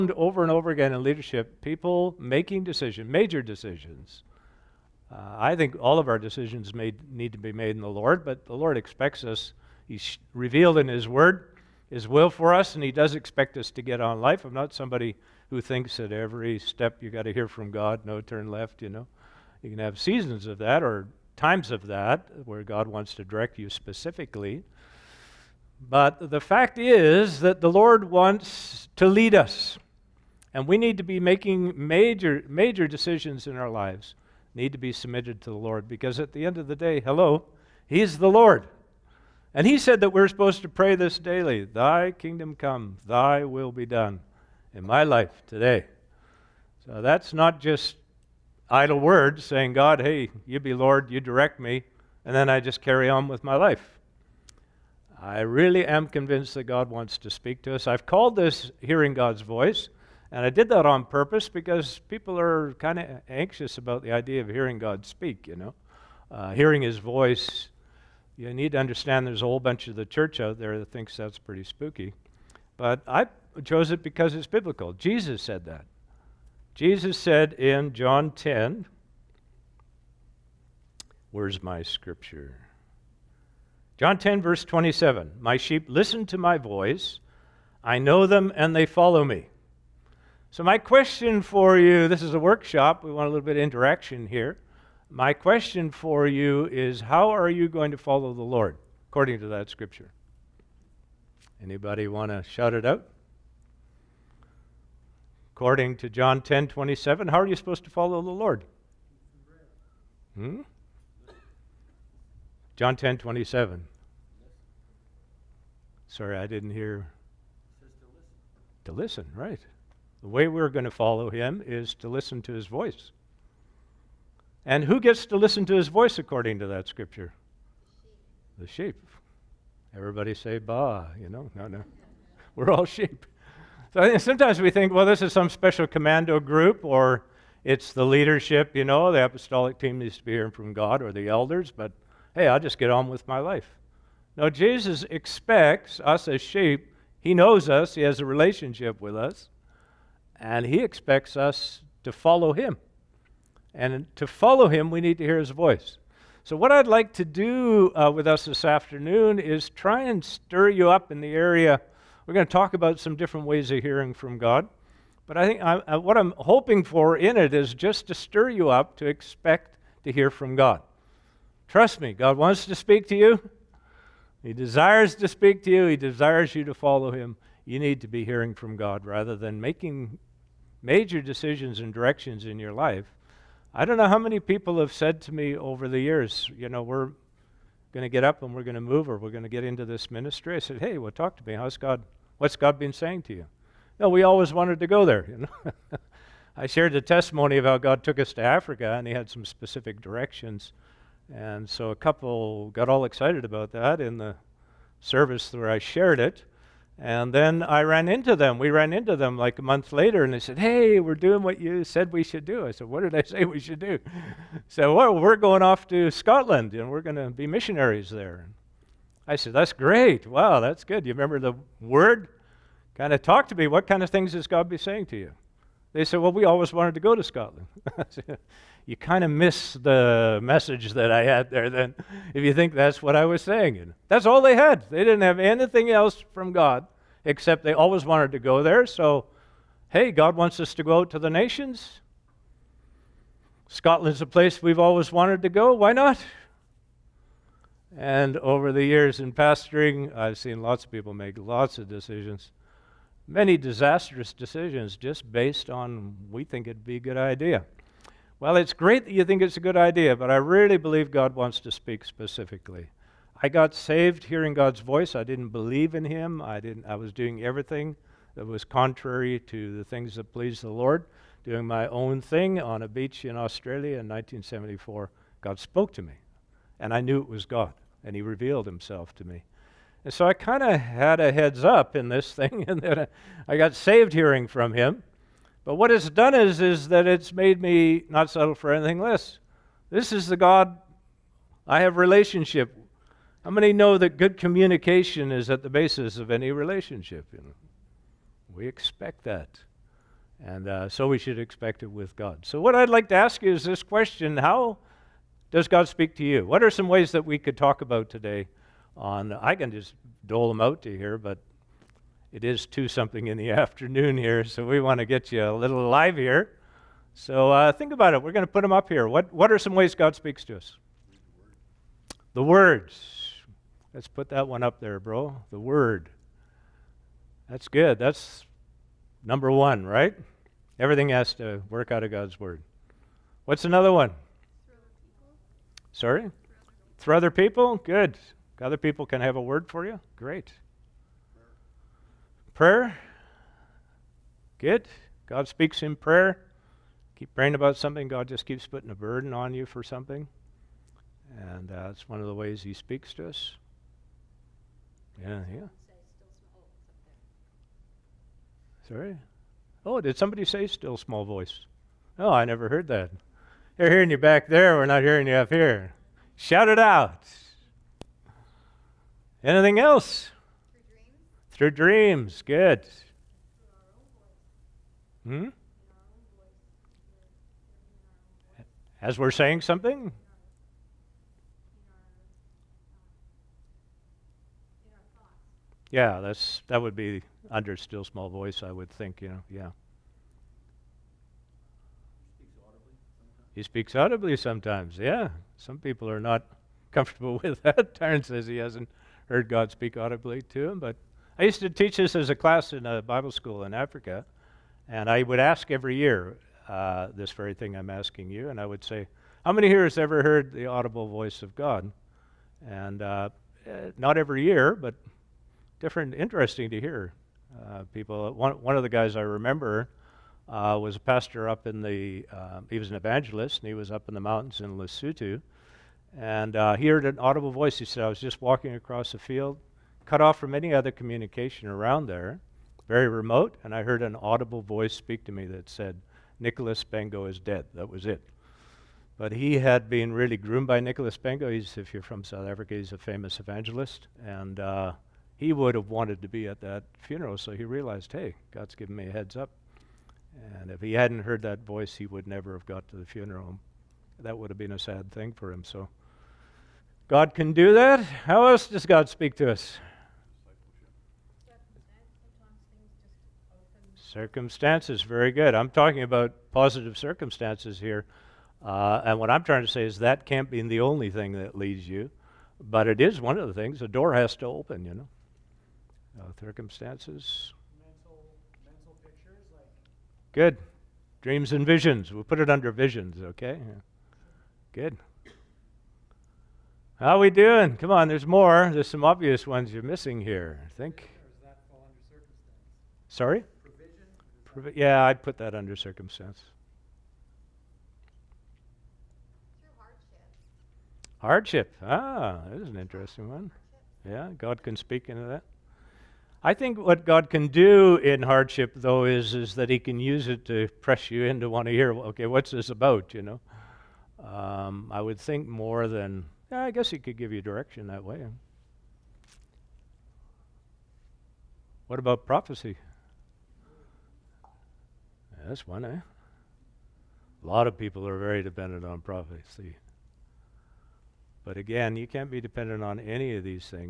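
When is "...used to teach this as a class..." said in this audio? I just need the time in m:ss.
6:41.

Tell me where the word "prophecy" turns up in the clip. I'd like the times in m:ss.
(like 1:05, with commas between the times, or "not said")
8:42, 8:49.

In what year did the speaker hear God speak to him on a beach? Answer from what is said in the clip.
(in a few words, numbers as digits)
1974.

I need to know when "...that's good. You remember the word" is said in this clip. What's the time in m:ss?
3:40.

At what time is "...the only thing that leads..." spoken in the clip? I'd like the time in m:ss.
7:50.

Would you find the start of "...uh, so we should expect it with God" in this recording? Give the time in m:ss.
5:00.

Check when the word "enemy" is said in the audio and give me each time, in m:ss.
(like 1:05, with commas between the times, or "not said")
not said.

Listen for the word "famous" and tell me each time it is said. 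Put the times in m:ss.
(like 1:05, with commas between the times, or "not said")
7:22.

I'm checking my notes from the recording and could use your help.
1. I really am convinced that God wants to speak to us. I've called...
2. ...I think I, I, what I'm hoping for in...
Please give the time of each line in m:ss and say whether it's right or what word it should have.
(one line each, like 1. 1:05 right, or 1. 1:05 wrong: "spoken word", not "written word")
1. 0:55 right
2. 2:45 right.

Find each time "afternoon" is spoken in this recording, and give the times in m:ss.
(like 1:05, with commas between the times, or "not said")
2:38, 5:13.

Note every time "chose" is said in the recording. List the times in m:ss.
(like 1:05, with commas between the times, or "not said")
1:13.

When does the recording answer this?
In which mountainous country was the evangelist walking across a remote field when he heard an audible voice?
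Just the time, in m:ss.
7:04.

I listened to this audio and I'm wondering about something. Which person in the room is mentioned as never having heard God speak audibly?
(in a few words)
Taryn.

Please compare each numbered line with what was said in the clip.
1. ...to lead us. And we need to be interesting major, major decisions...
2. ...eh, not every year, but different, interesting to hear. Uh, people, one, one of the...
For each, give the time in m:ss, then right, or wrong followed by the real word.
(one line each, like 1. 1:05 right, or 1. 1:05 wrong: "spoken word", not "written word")
1. 0:28 wrong: "making", not "interesting"
2. 6:53 right.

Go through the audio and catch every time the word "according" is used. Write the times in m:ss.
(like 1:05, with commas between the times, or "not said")
1:39, 1:45, 2:06.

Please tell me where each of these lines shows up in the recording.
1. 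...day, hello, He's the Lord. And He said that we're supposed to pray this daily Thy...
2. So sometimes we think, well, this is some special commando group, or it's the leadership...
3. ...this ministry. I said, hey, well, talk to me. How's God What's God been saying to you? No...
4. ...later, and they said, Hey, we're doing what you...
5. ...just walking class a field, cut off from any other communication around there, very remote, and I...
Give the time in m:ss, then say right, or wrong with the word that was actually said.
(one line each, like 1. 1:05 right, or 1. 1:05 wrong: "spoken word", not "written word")
1. 0:36 right
2. 2:13 right
3. 3:09 right
4. 3:29 right
5. 7:08 wrong: "across", not "class".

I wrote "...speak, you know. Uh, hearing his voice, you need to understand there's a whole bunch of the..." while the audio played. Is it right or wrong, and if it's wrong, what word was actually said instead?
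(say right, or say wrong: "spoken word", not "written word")
right.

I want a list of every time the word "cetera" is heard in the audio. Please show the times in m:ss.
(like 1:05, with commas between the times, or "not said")
not said.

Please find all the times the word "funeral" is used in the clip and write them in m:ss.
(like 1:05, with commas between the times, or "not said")
7:27, 7:33.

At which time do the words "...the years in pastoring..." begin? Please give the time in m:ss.
4:08.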